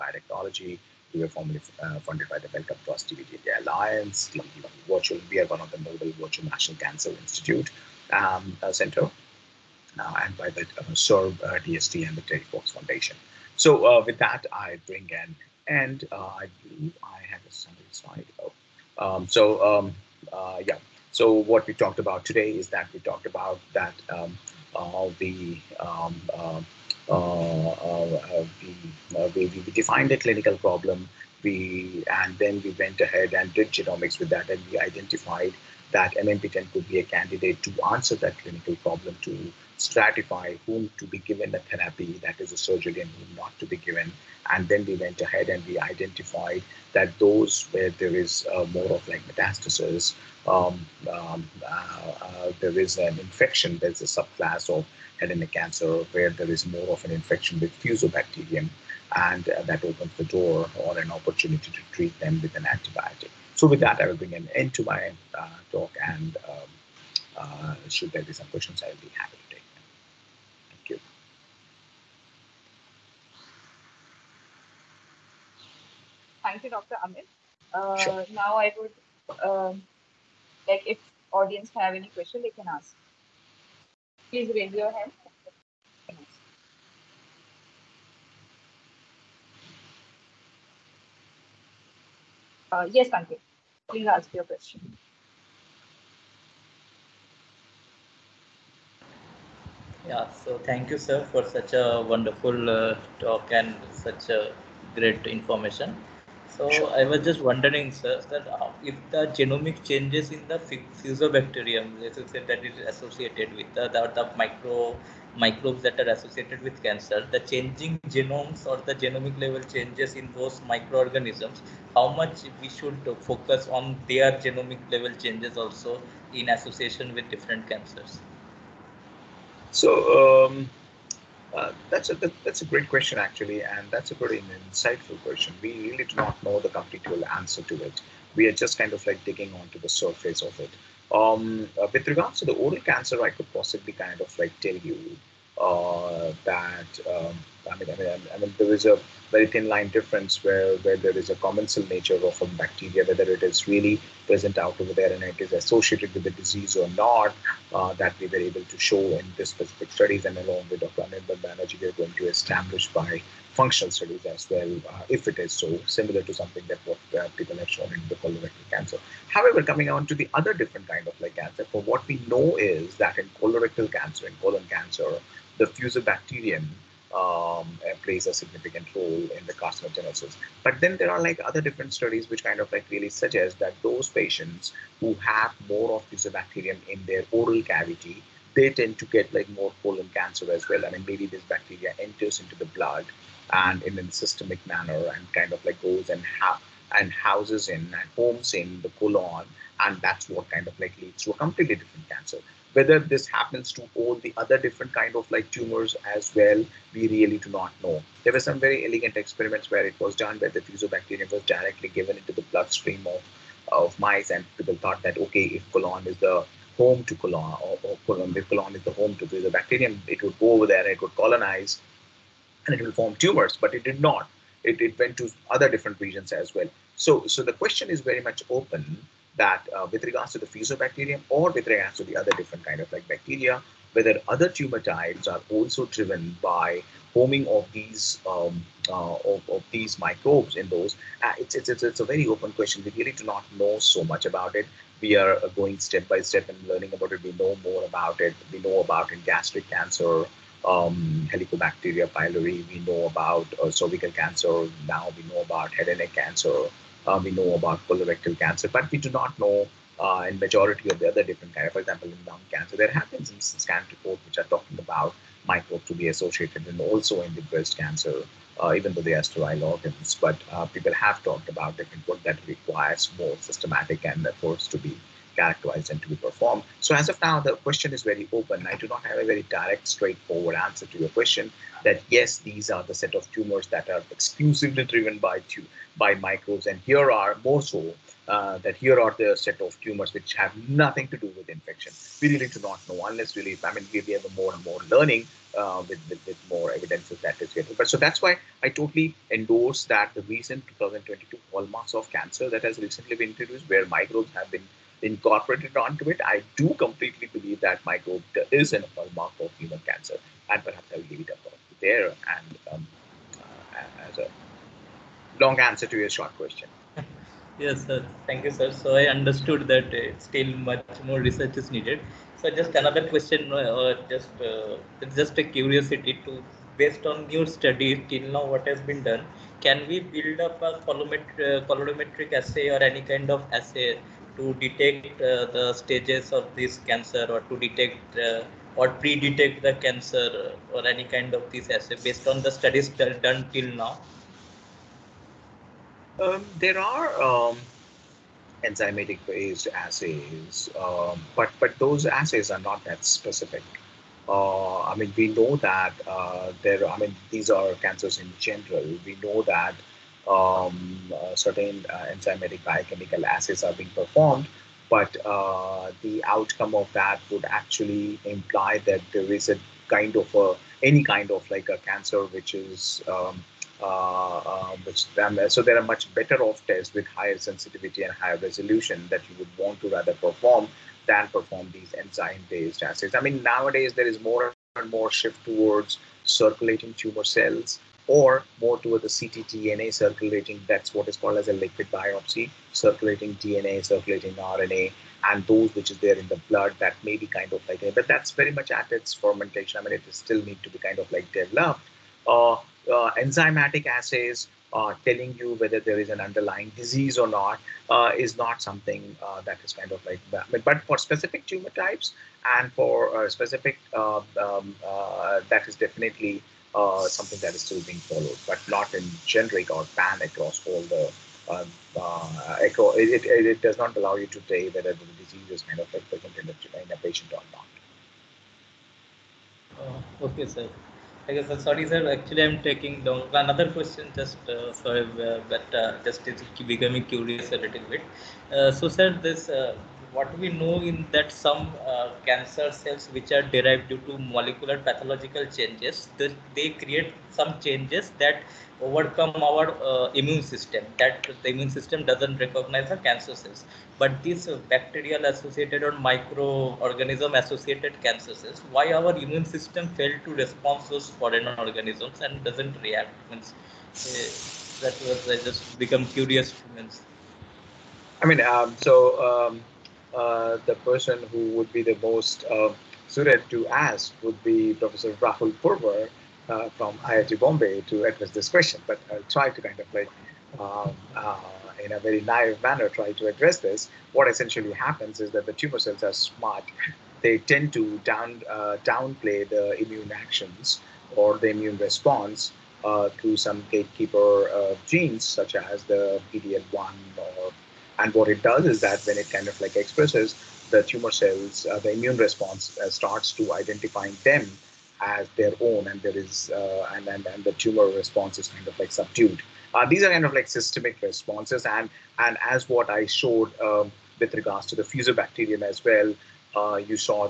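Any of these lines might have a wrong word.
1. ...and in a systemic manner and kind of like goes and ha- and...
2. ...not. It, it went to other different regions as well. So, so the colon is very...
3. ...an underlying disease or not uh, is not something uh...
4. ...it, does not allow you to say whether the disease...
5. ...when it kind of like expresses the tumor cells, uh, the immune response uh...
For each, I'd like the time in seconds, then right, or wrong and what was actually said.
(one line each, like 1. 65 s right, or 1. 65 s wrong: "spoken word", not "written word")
1. 193 s right
2. 223 s wrong: "question", not "colon"
3. 406 s right
4. 423 s right
5. 499 s right.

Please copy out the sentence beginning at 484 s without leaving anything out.
What essentially happens is that the tumor cells are smart.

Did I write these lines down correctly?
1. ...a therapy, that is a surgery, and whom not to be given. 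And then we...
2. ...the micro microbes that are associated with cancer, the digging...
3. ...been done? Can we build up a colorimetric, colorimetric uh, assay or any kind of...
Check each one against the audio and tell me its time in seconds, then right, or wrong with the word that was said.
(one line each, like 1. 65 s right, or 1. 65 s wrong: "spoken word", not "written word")
1. 41 s right
2. 114 s wrong: "changing", not "digging"
3. 328 s right.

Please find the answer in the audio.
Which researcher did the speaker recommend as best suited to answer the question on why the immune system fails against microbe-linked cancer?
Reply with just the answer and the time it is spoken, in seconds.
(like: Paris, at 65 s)
Rahul Purwar, at 475 s.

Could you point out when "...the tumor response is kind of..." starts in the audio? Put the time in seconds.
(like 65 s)
507 s.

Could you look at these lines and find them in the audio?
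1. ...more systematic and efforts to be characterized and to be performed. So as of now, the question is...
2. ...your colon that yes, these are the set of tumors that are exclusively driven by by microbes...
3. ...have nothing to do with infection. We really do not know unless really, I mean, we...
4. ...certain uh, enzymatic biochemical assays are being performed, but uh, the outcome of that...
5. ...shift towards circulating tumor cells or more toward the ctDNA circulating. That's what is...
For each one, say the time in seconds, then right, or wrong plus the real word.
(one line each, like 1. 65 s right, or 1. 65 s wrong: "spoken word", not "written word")
1. 273 s right
2. 280 s wrong: "question", not "colon"
3. 290 s right
4. 361 s right
5. 385 s right.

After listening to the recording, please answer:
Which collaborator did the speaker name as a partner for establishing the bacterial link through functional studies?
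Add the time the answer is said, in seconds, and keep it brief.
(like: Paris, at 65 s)
Anirban Banerjee, at 161 s.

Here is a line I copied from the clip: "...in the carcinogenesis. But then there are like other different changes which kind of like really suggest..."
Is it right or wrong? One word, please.
wrong.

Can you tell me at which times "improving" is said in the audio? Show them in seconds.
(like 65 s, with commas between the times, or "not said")
not said.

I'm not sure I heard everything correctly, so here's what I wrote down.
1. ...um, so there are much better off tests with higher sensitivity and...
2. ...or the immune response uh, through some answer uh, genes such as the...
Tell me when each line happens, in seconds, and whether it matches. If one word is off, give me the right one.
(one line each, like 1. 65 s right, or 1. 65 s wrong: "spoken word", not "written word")
1. 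375 s right
2. 491 s wrong: "gatekeeper", not "answer".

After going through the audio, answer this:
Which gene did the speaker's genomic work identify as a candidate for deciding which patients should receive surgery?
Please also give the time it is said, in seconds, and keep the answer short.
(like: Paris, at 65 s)
MMP10, at 36 s.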